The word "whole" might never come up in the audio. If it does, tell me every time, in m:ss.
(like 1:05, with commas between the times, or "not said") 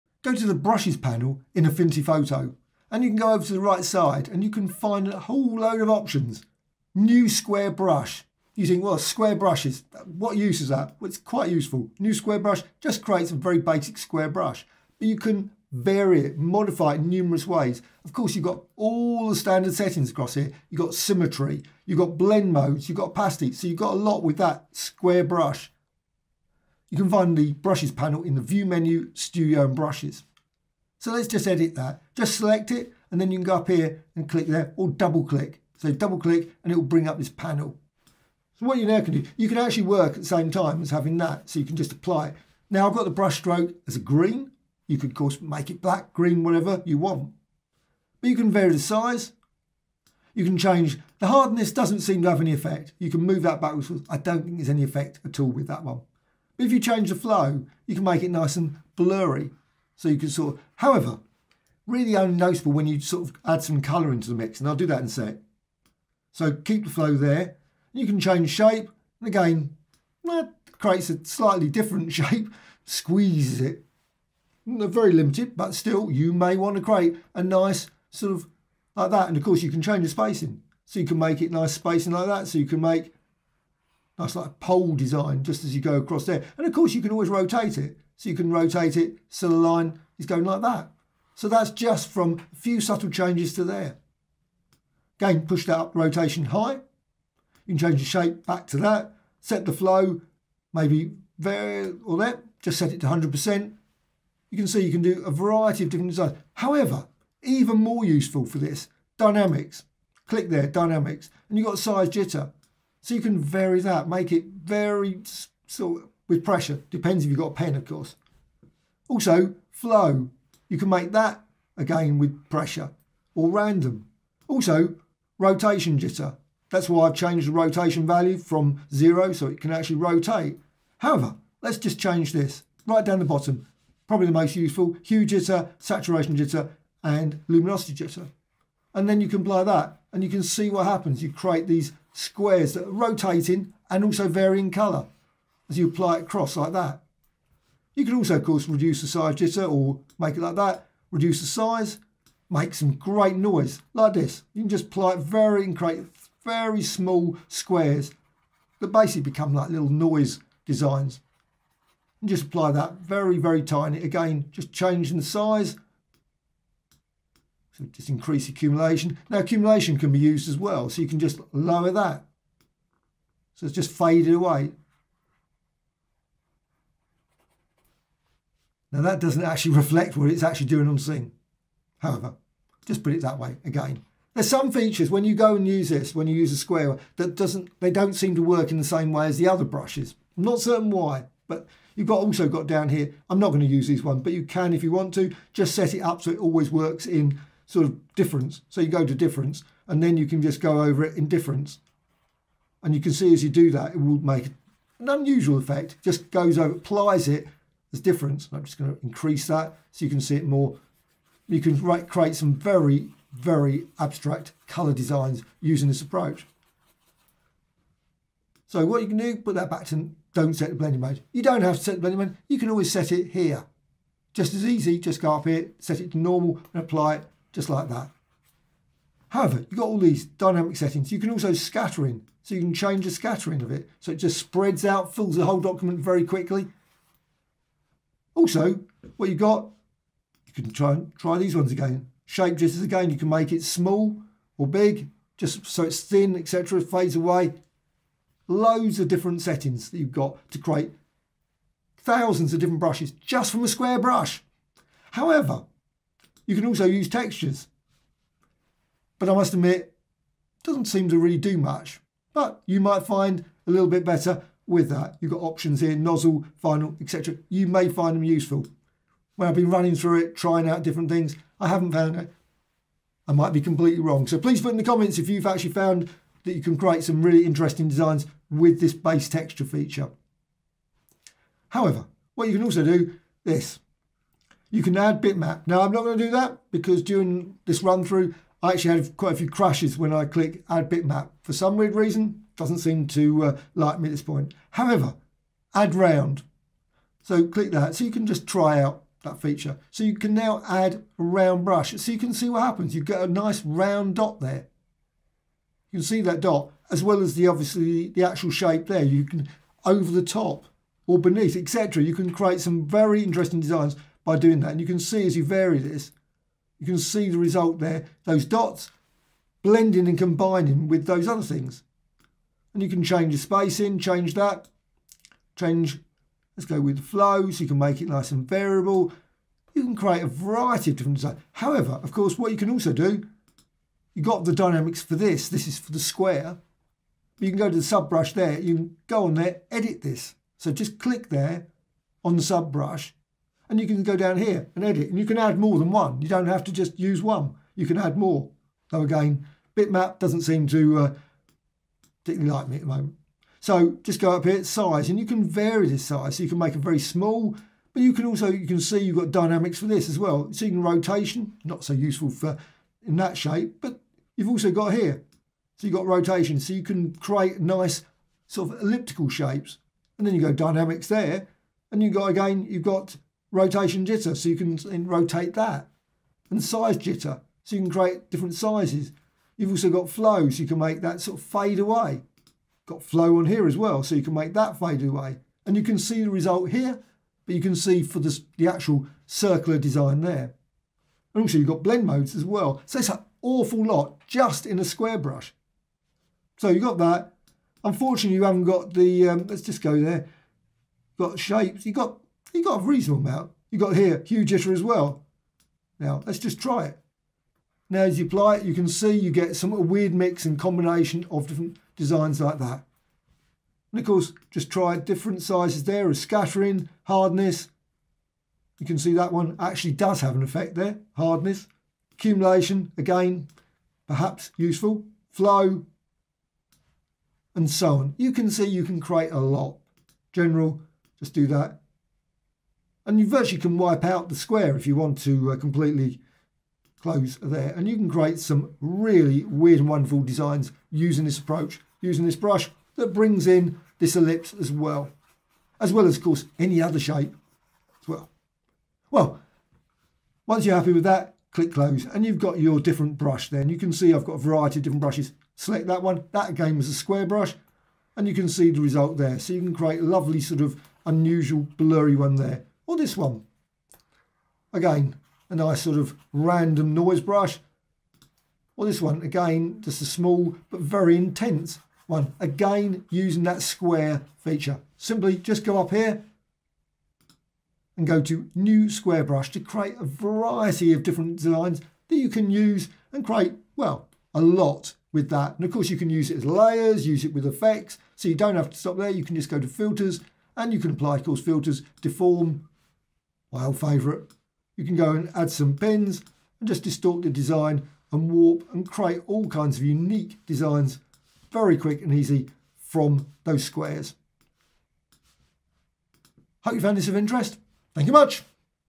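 0:05, 3:55.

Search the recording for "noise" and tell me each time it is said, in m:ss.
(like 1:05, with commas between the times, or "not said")
2:33, 2:39, 7:46.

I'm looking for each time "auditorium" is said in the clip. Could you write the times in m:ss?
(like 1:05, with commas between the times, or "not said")
not said.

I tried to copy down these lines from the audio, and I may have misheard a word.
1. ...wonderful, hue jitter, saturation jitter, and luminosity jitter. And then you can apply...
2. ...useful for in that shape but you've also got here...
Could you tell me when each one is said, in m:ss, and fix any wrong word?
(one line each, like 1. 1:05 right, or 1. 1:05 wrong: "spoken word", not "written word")
1. 2:14 wrong: "useful", not "wonderful"
2. 6:01 right.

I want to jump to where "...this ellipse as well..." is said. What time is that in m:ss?
7:23.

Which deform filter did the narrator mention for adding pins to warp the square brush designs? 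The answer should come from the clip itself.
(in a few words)
Wild favourite.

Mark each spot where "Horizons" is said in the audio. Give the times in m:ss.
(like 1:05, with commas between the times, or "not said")
not said.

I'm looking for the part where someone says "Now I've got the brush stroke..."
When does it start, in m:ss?
0:42.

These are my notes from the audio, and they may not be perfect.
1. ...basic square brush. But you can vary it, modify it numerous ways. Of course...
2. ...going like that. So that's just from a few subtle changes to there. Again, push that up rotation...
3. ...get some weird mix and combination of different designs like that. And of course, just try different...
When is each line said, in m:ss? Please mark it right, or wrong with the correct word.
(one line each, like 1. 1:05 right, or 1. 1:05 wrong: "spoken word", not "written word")
1. 0:13 right
2. 1:30 right
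3. 6:49 right.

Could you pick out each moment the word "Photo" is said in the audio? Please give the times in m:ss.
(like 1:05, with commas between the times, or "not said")
0:02.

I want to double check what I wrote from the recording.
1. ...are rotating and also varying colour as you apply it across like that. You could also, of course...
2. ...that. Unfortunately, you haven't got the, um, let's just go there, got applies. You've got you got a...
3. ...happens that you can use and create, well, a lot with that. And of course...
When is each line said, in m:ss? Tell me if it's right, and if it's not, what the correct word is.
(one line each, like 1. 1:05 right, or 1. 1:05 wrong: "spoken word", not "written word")
1. 2:22 right
2. 6:36 wrong: "shapes", not "applies"
3. 8:01 wrong: "designs", not "happens".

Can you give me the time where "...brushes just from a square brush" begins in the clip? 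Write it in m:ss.
4:12.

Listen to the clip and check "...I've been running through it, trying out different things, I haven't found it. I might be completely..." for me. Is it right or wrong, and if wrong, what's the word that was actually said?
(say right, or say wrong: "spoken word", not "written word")
right.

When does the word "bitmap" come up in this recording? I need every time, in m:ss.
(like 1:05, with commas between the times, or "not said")
4:45, 4:50, 5:49.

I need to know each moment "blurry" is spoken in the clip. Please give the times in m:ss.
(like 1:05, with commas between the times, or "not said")
0:58, 7:41.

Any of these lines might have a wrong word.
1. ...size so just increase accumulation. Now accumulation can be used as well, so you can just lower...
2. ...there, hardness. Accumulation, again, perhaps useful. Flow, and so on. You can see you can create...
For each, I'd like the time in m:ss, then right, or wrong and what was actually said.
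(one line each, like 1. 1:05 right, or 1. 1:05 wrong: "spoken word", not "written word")
1. 2:45 right
2. 7:00 right.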